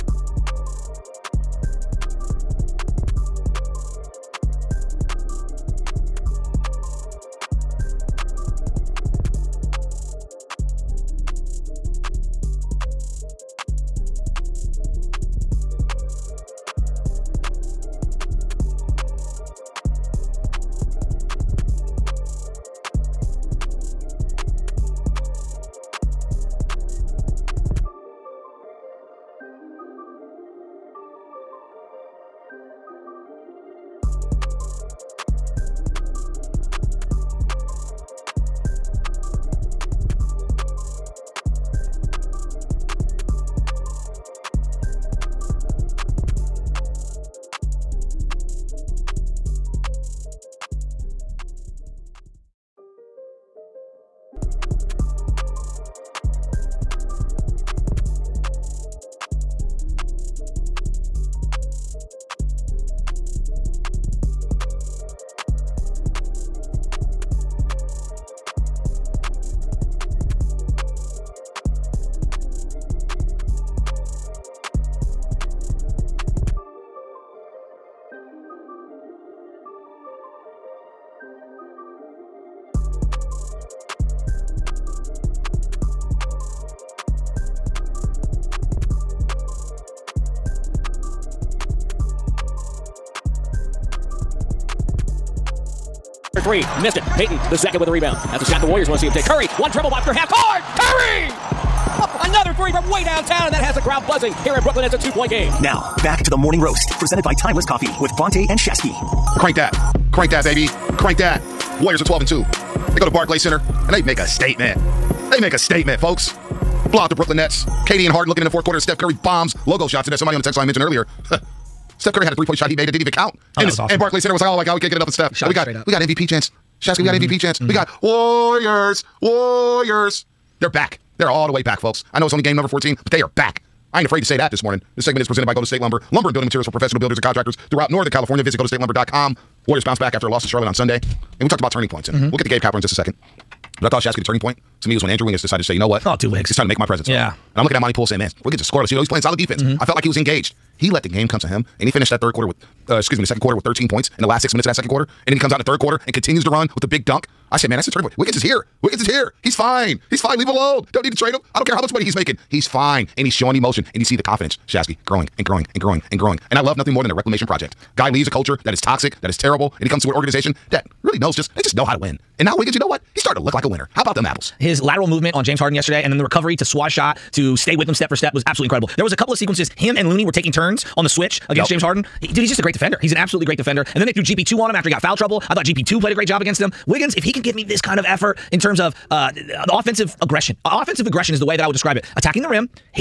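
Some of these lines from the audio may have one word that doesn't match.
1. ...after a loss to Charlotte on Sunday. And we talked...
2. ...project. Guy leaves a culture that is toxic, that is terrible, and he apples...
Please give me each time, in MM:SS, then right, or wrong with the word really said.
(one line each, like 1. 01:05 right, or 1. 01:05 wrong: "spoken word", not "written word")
1. 02:20 right
2. 02:47 wrong: "comes", not "apples".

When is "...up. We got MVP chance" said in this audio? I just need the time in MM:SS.
02:05.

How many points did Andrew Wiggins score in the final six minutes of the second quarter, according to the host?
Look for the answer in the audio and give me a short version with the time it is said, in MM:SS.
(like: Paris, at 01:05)
13, at 02:33.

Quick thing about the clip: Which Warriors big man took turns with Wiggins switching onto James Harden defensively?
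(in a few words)
Looney.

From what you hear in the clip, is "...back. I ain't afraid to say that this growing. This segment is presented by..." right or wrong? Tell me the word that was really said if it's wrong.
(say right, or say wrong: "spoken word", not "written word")
wrong: "morning", not "growing".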